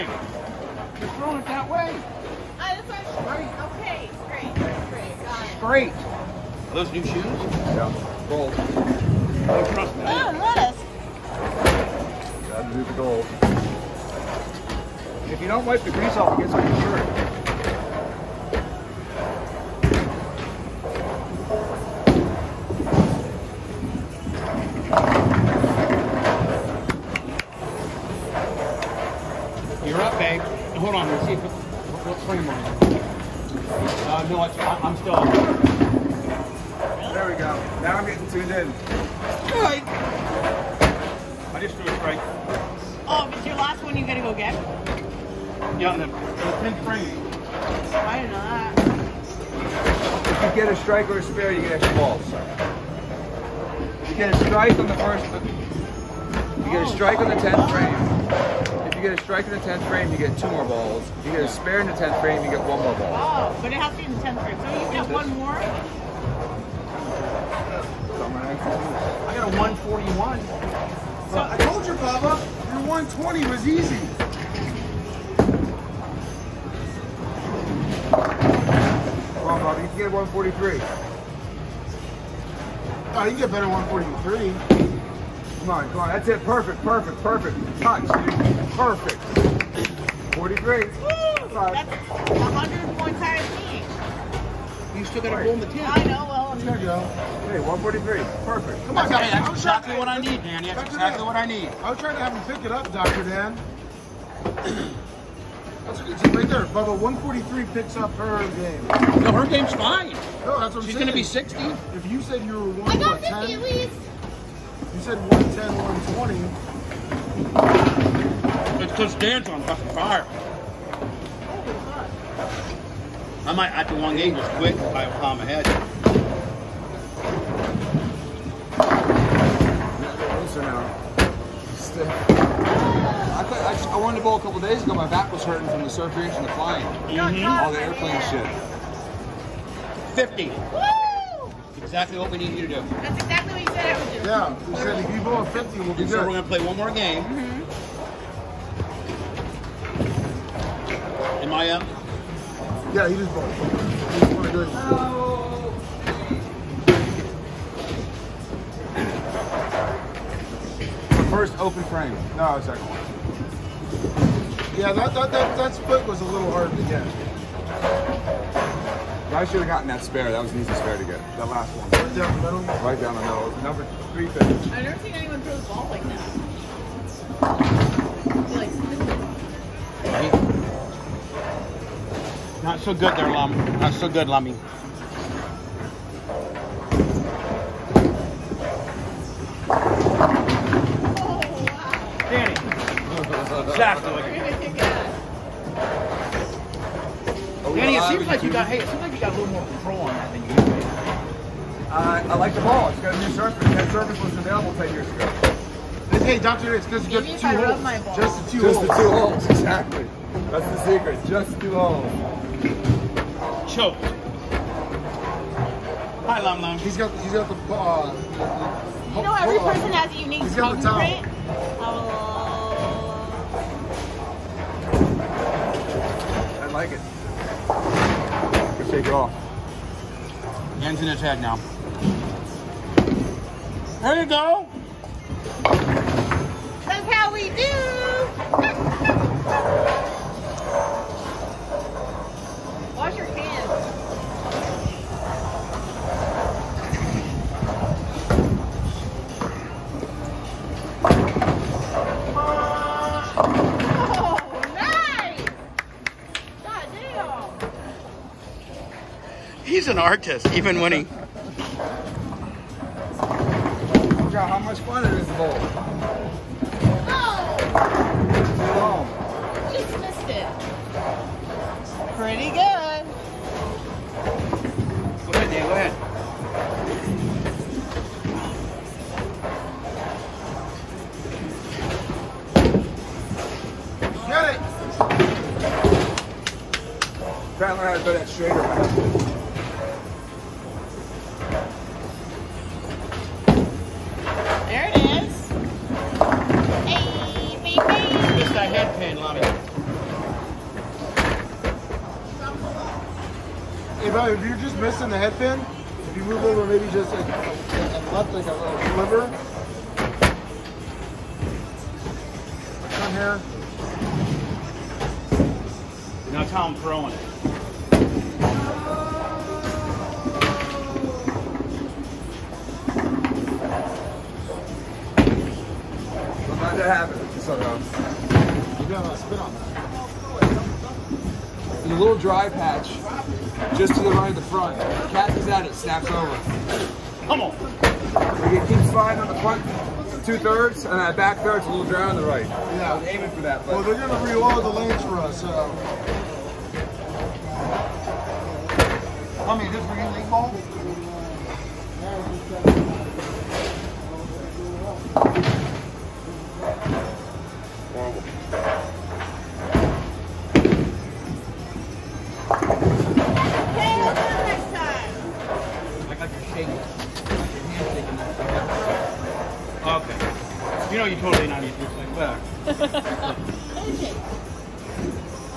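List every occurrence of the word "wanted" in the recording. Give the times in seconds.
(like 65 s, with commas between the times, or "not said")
133 s, 154 s.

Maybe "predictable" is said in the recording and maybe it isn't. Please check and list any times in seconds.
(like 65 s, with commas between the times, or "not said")
not said.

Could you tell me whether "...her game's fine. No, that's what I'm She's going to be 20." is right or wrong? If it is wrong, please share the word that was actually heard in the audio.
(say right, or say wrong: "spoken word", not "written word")
wrong: "60", not "20".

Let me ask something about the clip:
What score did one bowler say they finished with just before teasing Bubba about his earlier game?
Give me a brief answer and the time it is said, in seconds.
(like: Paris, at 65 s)
141, at 69 s.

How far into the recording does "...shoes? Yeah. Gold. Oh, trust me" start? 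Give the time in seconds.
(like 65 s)
7 s.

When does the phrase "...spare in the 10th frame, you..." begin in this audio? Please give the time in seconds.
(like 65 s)
61 s.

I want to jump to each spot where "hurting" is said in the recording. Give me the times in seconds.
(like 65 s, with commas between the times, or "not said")
135 s.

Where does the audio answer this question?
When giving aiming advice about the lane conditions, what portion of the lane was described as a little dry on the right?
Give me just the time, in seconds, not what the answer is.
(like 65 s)
341 s.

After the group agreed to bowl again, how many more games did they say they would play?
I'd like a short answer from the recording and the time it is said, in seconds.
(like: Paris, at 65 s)
one more game, at 146 s.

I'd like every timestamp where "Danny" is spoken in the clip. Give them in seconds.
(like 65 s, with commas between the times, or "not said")
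100 s, 184 s, 197 s.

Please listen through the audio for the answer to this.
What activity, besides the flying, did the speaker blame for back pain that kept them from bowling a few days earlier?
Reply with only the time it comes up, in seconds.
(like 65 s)
135 s.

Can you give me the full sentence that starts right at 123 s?
I might have to one game just quick by the time ahead.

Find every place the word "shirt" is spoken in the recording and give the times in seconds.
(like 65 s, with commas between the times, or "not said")
16 s.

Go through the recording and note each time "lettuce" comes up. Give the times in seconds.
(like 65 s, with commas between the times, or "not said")
10 s.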